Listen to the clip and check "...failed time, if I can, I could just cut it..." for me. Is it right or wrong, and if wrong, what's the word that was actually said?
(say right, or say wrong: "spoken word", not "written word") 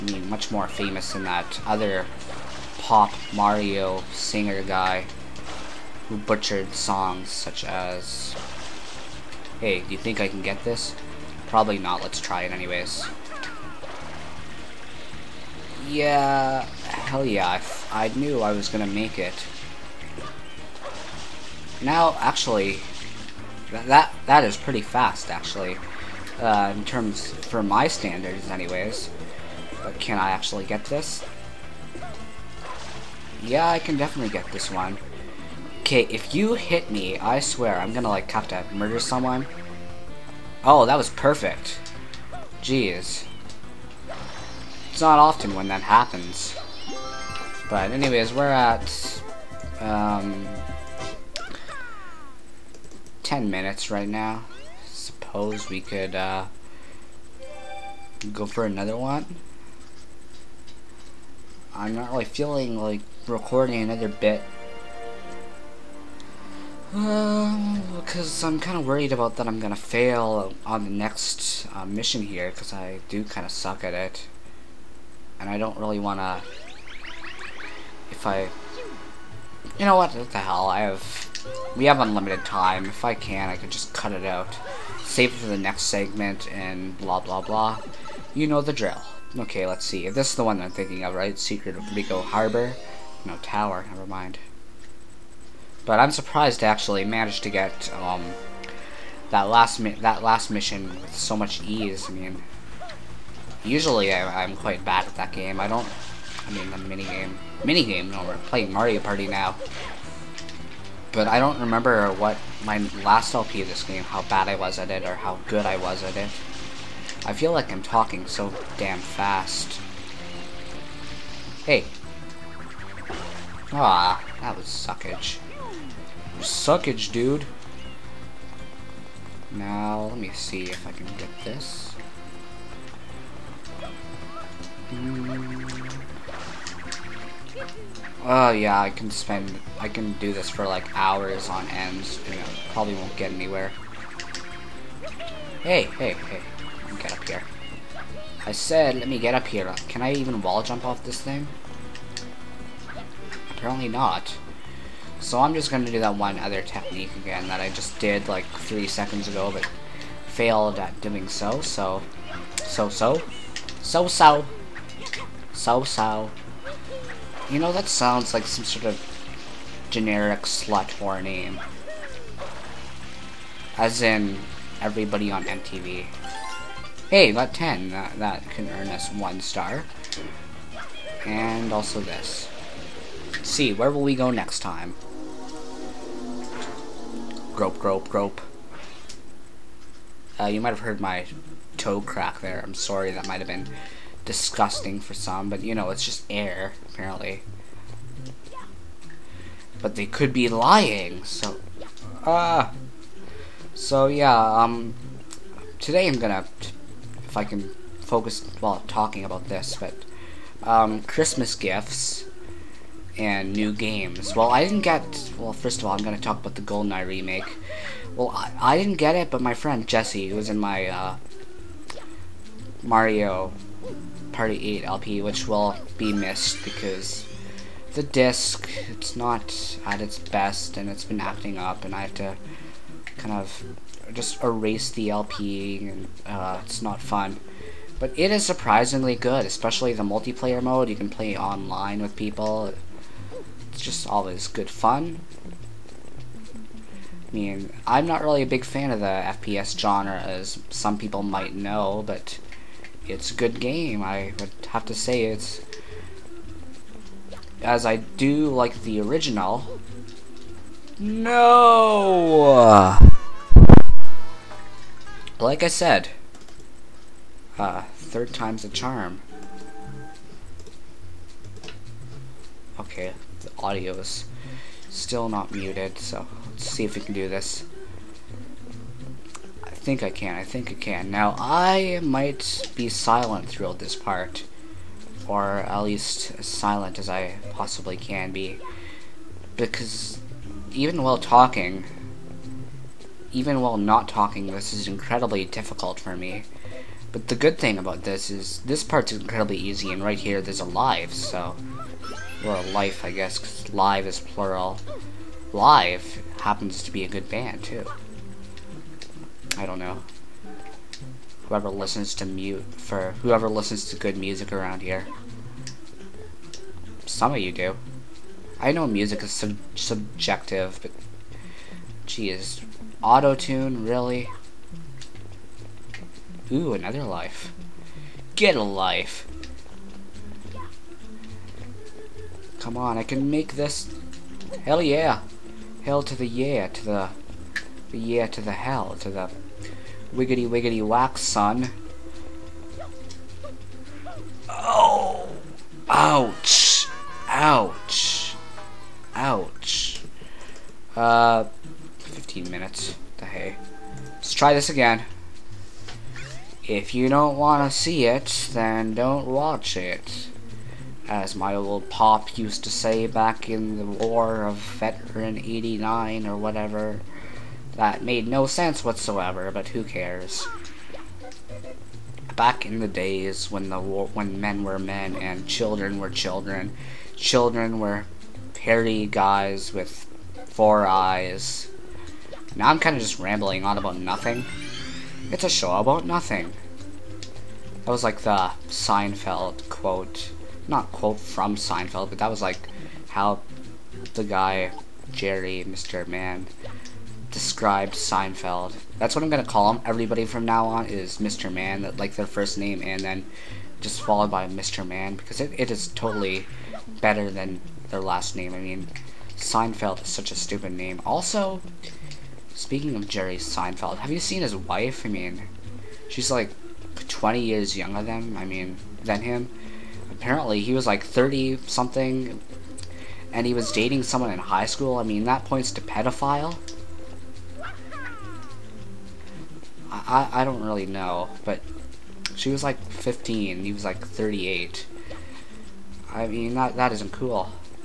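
wrong: "unlimited", not "failed".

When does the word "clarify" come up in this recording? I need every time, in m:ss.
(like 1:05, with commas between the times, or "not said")
not said.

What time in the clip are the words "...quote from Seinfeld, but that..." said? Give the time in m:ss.
6:30.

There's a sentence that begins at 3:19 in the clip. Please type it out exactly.
But they could be lying, so.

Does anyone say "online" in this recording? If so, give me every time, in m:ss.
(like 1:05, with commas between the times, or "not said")
4:01.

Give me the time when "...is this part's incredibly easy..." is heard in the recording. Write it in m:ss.
4:58.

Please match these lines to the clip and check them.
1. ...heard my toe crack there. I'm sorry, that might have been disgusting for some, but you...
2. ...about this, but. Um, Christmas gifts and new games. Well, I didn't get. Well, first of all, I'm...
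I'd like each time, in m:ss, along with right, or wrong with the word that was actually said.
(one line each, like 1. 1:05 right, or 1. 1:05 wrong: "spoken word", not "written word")
1. 3:10 right
2. 3:29 right.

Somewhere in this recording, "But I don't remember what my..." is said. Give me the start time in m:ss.
1:51.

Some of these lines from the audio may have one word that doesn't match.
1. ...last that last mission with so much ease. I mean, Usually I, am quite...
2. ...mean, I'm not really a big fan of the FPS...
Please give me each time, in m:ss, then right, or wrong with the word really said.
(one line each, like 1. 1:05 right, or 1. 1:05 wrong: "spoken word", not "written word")
1. 1:39 right
2. 4:07 right.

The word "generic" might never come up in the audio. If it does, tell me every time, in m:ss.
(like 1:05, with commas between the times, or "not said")
2:49.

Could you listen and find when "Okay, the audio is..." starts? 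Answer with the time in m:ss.
4:32.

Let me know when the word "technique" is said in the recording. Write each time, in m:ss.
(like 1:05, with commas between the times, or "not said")
2:36.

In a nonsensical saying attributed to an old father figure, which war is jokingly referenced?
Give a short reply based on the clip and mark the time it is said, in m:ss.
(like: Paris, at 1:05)
War of Veteran 89, at 6:04.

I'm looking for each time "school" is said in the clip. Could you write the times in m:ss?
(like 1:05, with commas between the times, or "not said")
7:04.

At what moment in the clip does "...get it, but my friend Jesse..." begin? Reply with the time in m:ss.
3:38.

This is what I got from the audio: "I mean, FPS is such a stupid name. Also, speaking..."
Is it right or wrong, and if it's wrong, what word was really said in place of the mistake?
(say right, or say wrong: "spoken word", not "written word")
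wrong: "Seinfeld", not "FPS".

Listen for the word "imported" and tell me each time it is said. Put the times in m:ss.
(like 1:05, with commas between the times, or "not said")
not said.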